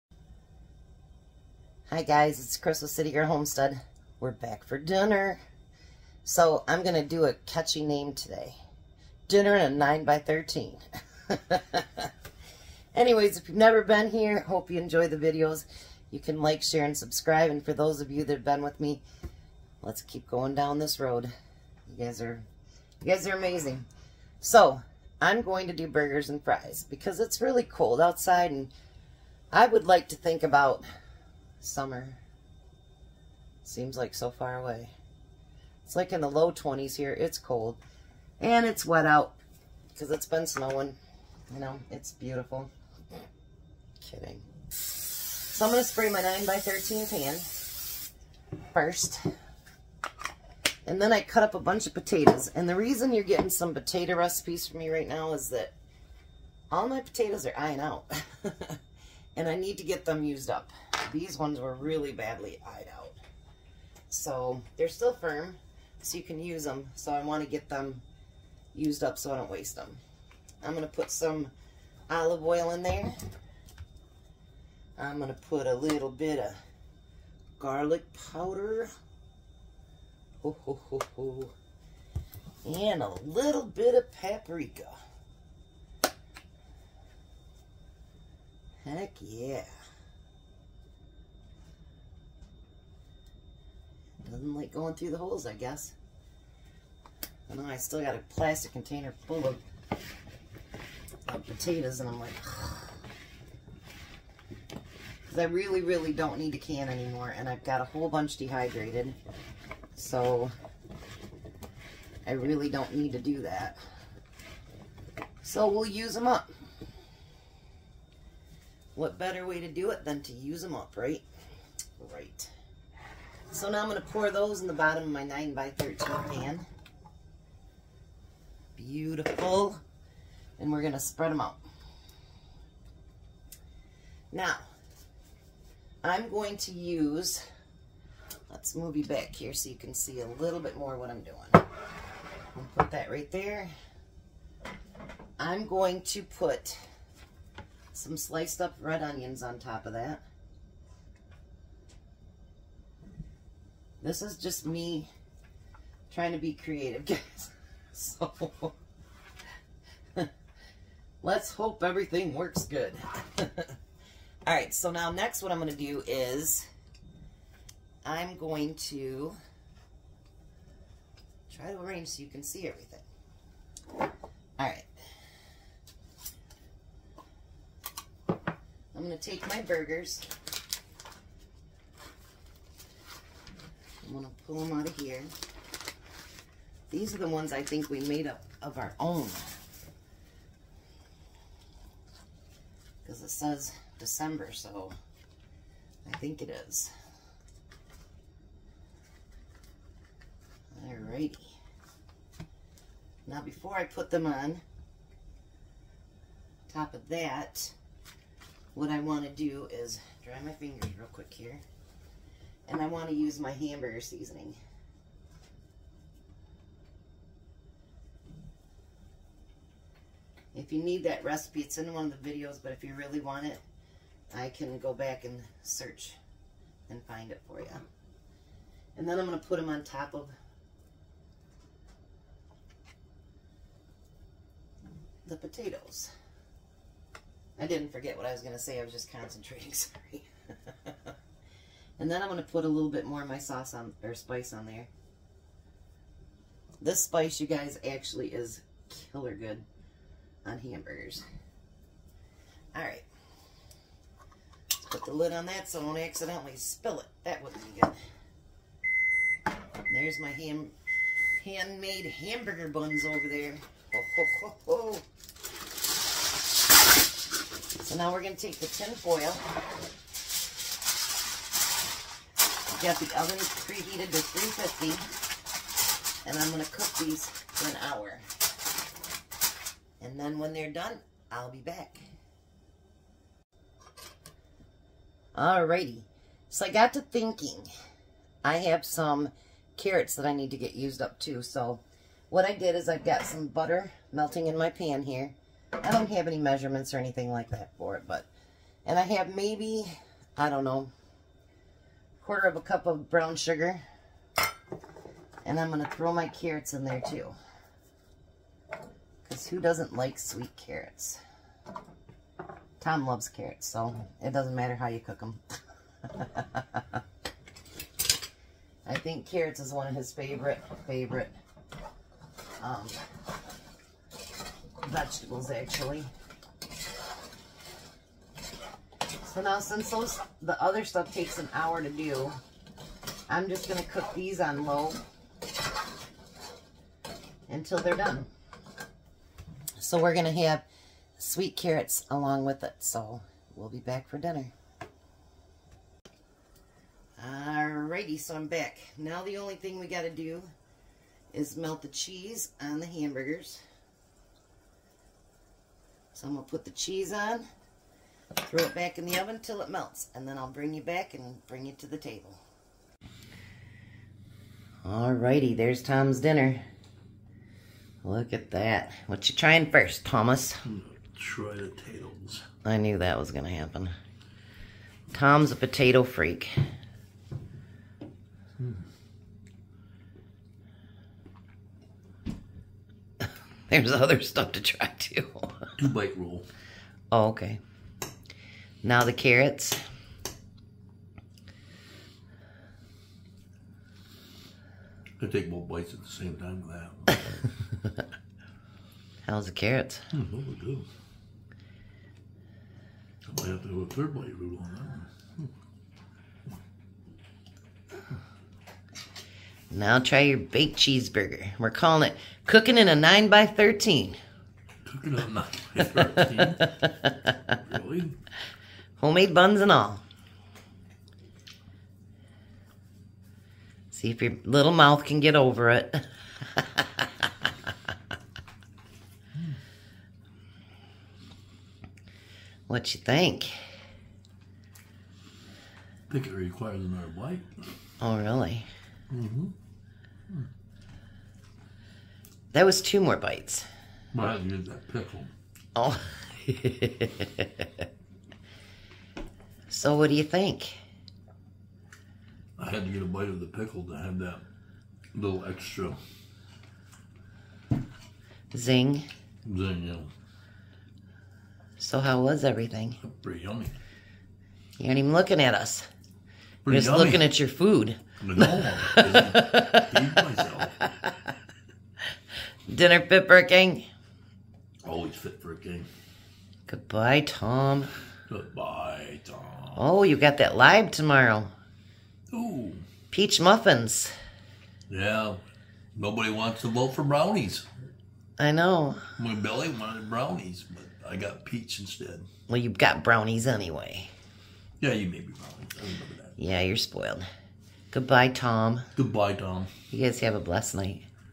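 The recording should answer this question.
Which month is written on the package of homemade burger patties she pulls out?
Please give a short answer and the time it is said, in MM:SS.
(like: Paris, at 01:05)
December, at 03:13.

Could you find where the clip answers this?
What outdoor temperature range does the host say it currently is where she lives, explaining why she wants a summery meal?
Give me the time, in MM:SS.
00:36.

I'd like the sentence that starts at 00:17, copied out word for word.
And for those of you that have been with me, let's keep going down this road.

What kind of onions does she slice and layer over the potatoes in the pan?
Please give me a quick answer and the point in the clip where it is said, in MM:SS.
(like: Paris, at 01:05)
red onions, at 02:28.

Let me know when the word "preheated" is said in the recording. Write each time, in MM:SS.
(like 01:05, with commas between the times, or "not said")
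04:33.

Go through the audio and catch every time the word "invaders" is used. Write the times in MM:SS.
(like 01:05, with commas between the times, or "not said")
not said.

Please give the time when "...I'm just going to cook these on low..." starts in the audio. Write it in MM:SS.
05:33.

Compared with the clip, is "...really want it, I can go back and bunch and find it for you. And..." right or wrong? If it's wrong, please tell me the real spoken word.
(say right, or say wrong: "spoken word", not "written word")
wrong: "search", not "bunch".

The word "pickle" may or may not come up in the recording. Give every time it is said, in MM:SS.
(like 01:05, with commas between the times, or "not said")
07:24, 07:33.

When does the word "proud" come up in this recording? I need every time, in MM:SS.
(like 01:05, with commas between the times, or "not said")
not said.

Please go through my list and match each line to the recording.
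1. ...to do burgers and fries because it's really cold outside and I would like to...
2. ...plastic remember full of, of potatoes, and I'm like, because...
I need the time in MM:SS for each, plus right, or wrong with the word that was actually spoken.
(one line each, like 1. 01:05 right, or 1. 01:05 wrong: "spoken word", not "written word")
1. 00:25 right
2. 01:38 wrong: "container", not "remember".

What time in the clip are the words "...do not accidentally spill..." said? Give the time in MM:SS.
04:15.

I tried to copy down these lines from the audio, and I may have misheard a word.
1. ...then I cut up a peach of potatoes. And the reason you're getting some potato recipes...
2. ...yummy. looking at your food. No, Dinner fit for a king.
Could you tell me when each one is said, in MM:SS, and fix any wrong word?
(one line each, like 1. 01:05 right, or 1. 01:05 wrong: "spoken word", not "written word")
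1. 00:50 wrong: "bunch", not "peach"
2. 07:46 right.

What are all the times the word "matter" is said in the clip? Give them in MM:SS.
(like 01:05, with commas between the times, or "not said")
05:14.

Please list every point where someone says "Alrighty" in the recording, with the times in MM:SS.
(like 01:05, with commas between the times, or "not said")
03:20, 04:45, 05:47, 06:04.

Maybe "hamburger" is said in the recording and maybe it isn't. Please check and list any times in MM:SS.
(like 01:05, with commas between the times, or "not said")
03:33, 04:10, 04:22, 05:52.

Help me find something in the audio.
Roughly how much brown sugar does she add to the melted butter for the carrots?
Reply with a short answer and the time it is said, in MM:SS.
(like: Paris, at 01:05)
quarter of a cup, at 05:02.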